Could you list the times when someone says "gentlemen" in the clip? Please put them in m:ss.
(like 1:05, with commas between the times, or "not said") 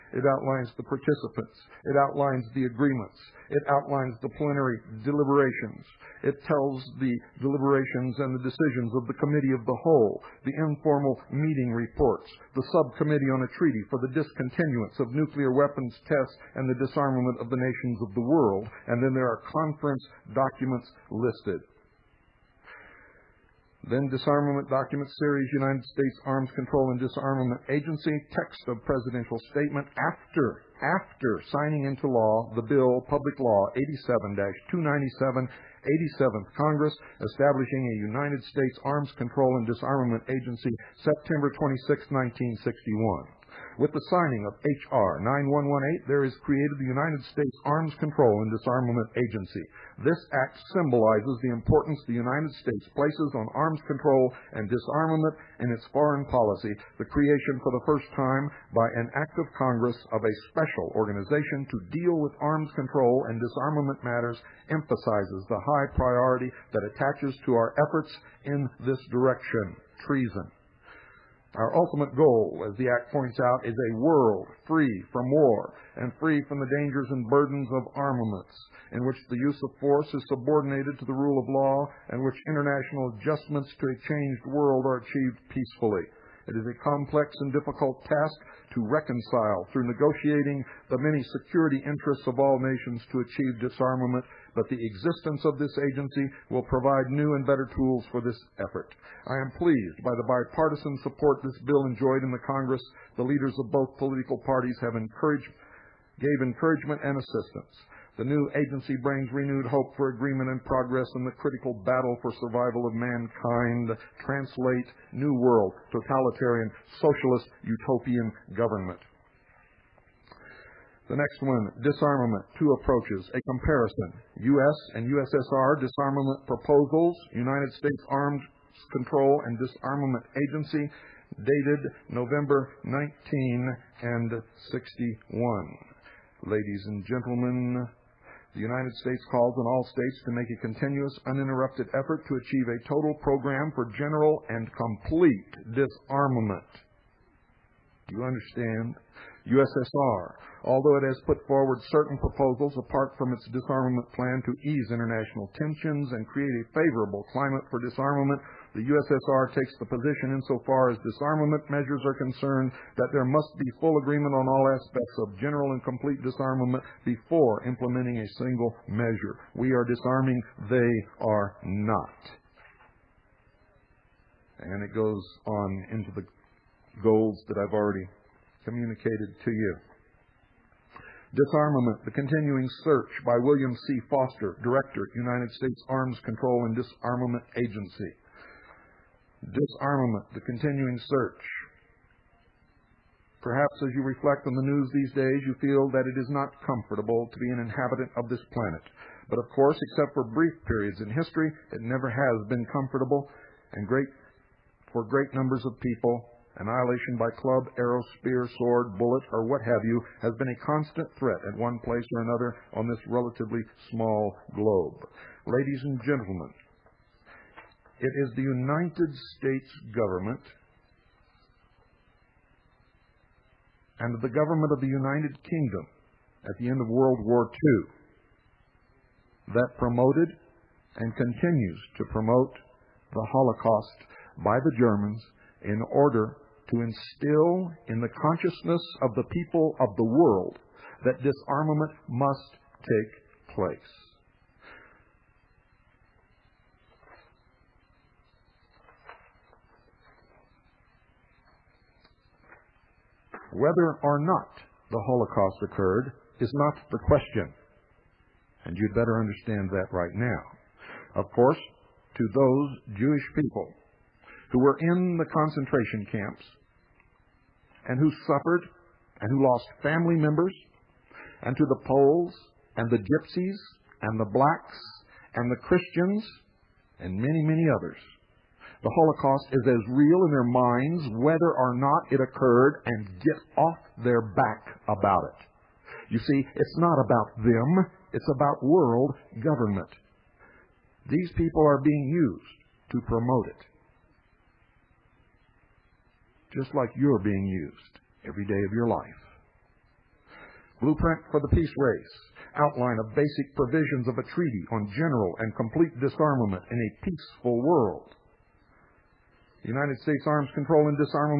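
2:17, 3:36.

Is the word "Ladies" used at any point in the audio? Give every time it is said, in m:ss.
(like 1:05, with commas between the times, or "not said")
2:16, 3:35.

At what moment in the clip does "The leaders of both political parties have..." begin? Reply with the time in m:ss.
1:43.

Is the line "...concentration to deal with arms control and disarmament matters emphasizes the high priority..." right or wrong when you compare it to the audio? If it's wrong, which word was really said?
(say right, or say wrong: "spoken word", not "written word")
wrong: "organization", not "concentration".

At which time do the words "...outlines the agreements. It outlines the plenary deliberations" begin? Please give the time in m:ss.
0:01.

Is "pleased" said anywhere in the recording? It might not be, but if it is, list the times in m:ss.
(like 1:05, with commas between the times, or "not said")
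1:39.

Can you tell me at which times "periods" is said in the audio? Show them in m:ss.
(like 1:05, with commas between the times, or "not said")
3:20.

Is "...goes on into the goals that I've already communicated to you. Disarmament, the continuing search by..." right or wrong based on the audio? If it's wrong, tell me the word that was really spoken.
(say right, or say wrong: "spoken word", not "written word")
right.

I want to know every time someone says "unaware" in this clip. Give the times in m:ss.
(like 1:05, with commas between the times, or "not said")
not said.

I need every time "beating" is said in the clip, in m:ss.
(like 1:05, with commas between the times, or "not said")
not said.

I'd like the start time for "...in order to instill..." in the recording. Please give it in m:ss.
3:55.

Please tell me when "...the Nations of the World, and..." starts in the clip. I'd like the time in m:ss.
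0:17.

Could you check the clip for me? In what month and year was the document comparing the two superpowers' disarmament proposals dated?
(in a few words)
November 1961.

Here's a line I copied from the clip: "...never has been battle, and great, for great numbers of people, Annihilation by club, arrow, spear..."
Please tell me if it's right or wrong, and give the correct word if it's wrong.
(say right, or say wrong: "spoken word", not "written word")
wrong: "comfortable", not "battle".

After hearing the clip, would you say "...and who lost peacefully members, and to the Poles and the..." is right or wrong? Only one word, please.
wrong.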